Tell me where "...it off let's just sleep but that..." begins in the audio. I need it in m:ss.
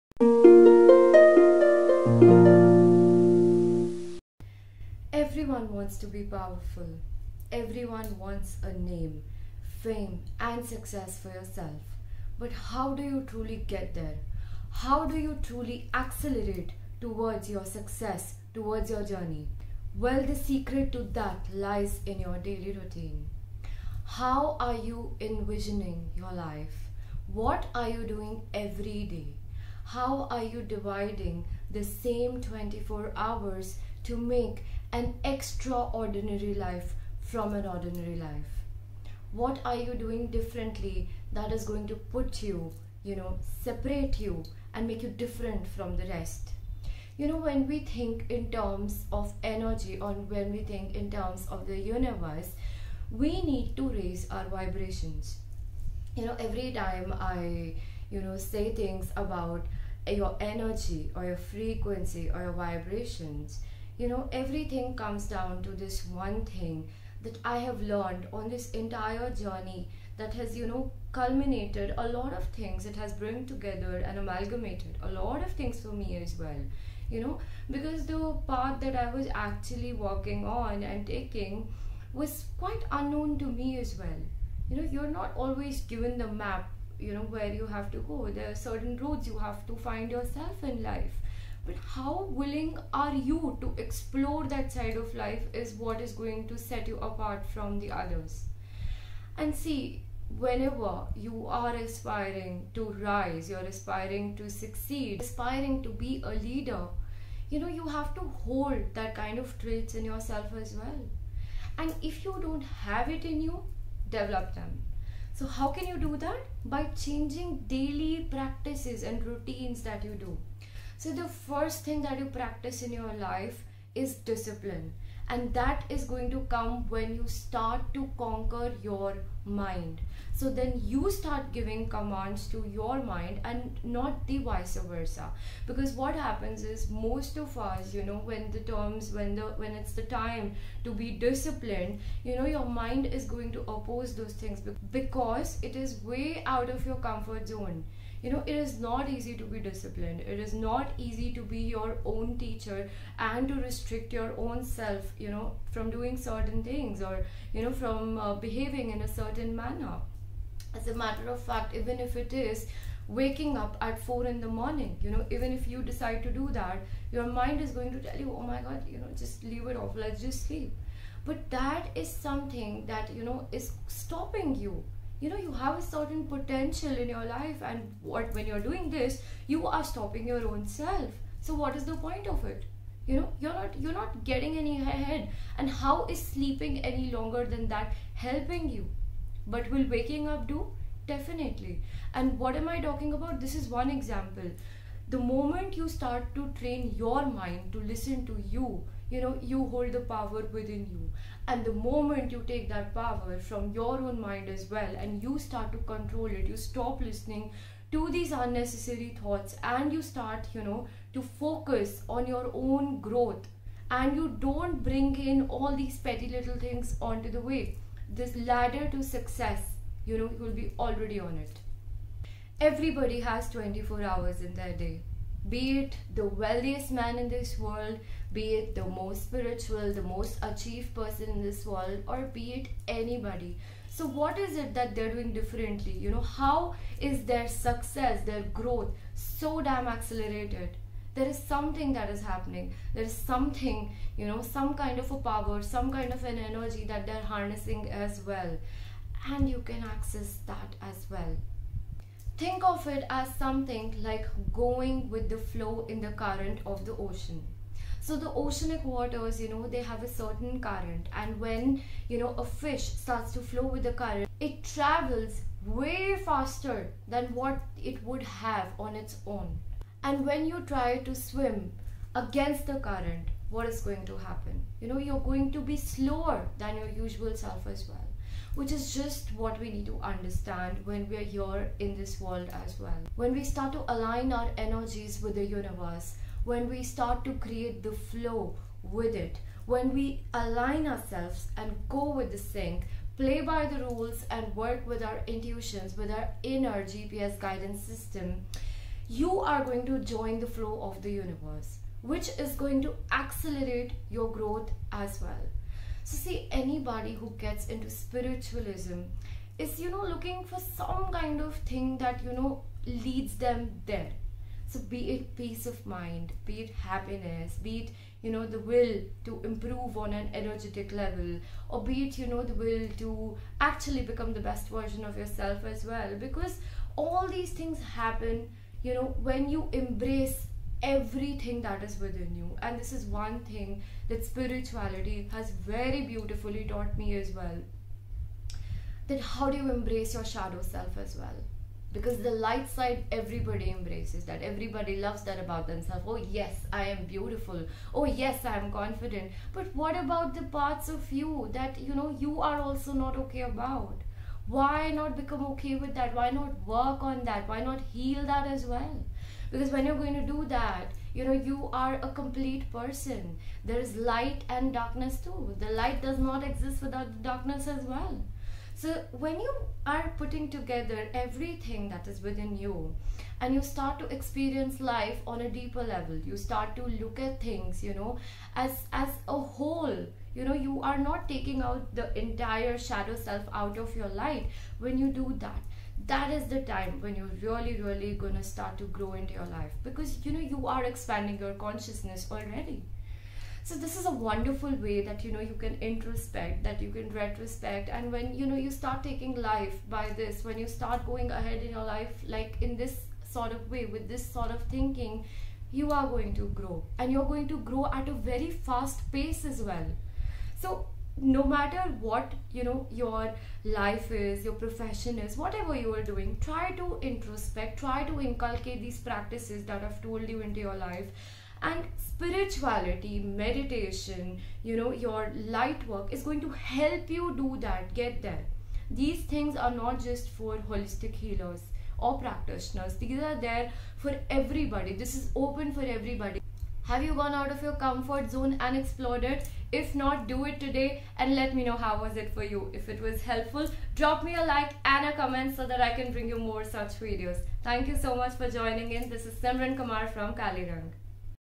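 2:49.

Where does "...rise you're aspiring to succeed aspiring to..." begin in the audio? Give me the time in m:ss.
1:43.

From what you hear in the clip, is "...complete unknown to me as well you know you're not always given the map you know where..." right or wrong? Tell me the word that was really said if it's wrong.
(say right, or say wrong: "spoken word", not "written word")
wrong: "quite", not "complete".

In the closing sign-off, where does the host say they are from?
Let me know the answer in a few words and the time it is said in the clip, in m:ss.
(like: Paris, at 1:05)
Kaliraang, at 7:30.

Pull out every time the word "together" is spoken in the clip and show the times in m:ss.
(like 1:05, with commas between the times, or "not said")
1:13, 6:10.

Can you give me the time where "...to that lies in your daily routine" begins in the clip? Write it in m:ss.
0:20.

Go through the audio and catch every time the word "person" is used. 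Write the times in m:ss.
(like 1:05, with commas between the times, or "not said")
3:50, 6:02.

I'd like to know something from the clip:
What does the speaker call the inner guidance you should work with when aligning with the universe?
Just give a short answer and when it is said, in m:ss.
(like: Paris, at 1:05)
inner GPS guidance system, at 4:56.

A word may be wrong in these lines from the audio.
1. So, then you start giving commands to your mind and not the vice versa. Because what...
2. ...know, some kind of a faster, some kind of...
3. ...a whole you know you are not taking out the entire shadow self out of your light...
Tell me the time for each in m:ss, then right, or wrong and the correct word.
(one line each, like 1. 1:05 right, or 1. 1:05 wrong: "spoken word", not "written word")
1. 2:10 right
2. 4:04 wrong: "power", not "faster"
3. 6:19 right.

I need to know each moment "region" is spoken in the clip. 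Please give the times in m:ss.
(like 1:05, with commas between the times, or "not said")
not said.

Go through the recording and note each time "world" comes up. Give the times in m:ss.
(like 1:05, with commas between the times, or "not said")
3:47, 3:51, 4:42.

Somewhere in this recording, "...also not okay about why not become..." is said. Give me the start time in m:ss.
5:52.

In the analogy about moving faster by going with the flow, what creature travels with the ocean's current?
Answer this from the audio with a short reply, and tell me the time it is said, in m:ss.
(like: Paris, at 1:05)
a fish, at 4:22.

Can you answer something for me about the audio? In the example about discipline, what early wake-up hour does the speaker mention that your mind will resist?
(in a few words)
4 in the morning.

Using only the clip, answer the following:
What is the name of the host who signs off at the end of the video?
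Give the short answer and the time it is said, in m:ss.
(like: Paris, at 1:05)
Simran Kumar, at 7:29.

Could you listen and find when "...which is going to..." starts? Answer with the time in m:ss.
5:02.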